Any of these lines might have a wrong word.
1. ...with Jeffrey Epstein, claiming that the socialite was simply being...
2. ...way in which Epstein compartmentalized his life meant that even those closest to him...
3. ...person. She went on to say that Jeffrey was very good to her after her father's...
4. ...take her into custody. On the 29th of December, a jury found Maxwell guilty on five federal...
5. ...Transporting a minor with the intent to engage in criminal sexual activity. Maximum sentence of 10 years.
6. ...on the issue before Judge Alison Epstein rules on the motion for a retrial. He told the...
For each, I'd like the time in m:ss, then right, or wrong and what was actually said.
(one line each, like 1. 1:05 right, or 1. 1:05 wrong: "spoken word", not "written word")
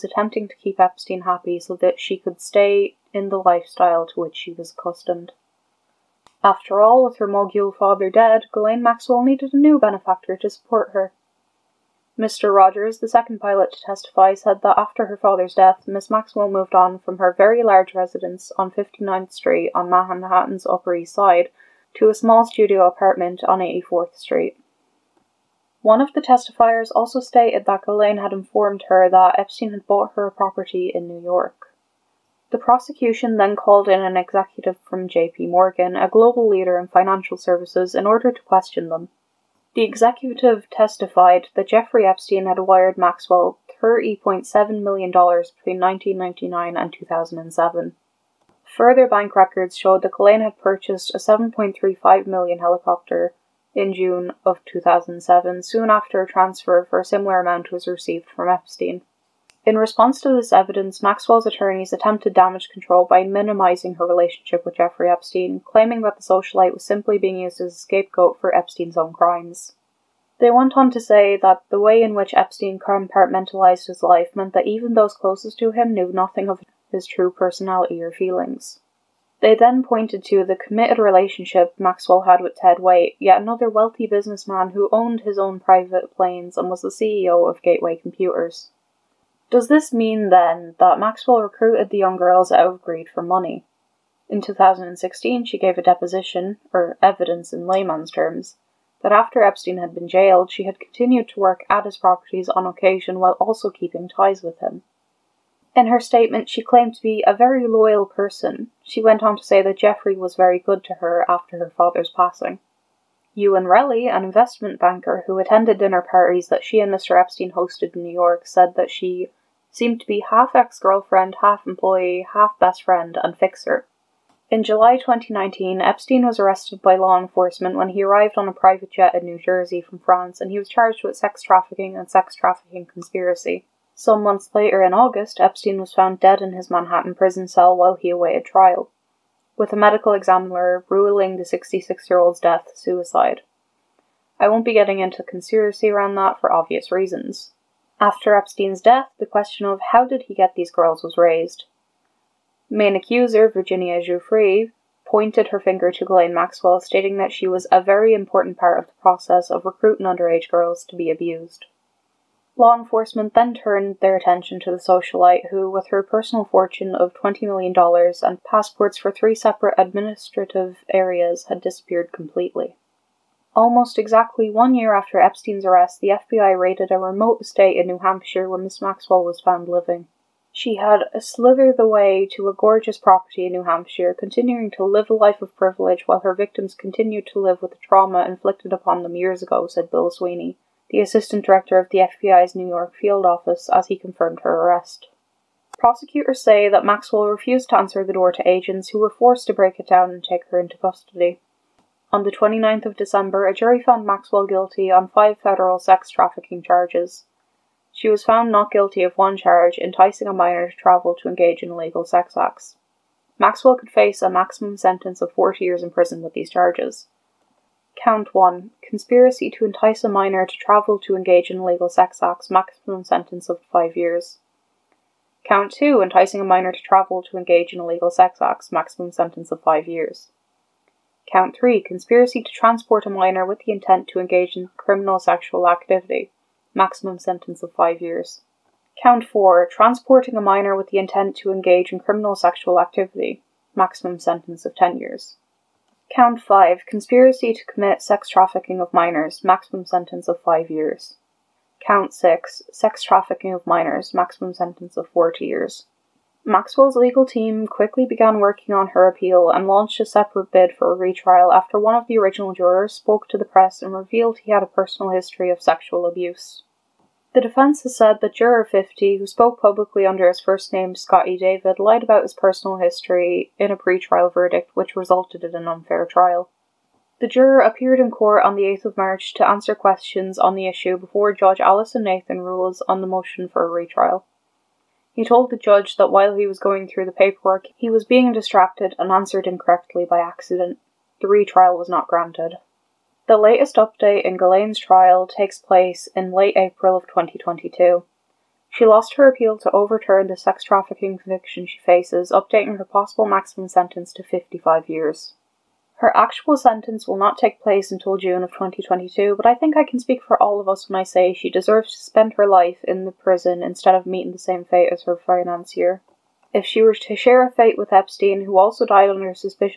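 1. 1:04 right
2. 1:11 right
3. 1:48 right
4. 3:20 right
5. 3:59 right
6. 4:40 wrong: "Nathan", not "Epstein".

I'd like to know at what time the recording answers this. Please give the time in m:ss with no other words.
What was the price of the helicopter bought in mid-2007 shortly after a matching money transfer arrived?
0:51.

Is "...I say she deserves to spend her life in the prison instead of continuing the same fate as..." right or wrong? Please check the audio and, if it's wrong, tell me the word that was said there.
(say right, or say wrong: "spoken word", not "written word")
wrong: "meeting", not "continuing".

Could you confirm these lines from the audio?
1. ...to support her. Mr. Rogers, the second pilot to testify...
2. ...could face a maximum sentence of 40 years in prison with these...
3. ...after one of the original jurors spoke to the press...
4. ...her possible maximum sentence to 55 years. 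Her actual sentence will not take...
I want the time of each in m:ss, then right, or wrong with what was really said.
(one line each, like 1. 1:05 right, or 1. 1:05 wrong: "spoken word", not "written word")
1. 0:10 right
2. 3:33 right
3. 4:21 right
4. 5:02 right.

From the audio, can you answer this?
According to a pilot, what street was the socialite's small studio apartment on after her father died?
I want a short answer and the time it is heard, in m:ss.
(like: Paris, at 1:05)
84th Street, at 0:23.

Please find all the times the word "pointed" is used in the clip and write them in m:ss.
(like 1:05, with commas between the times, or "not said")
1:19, 2:35.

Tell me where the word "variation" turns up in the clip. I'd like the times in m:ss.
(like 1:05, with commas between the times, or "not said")
not said.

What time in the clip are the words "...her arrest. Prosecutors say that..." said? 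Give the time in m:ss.
3:14.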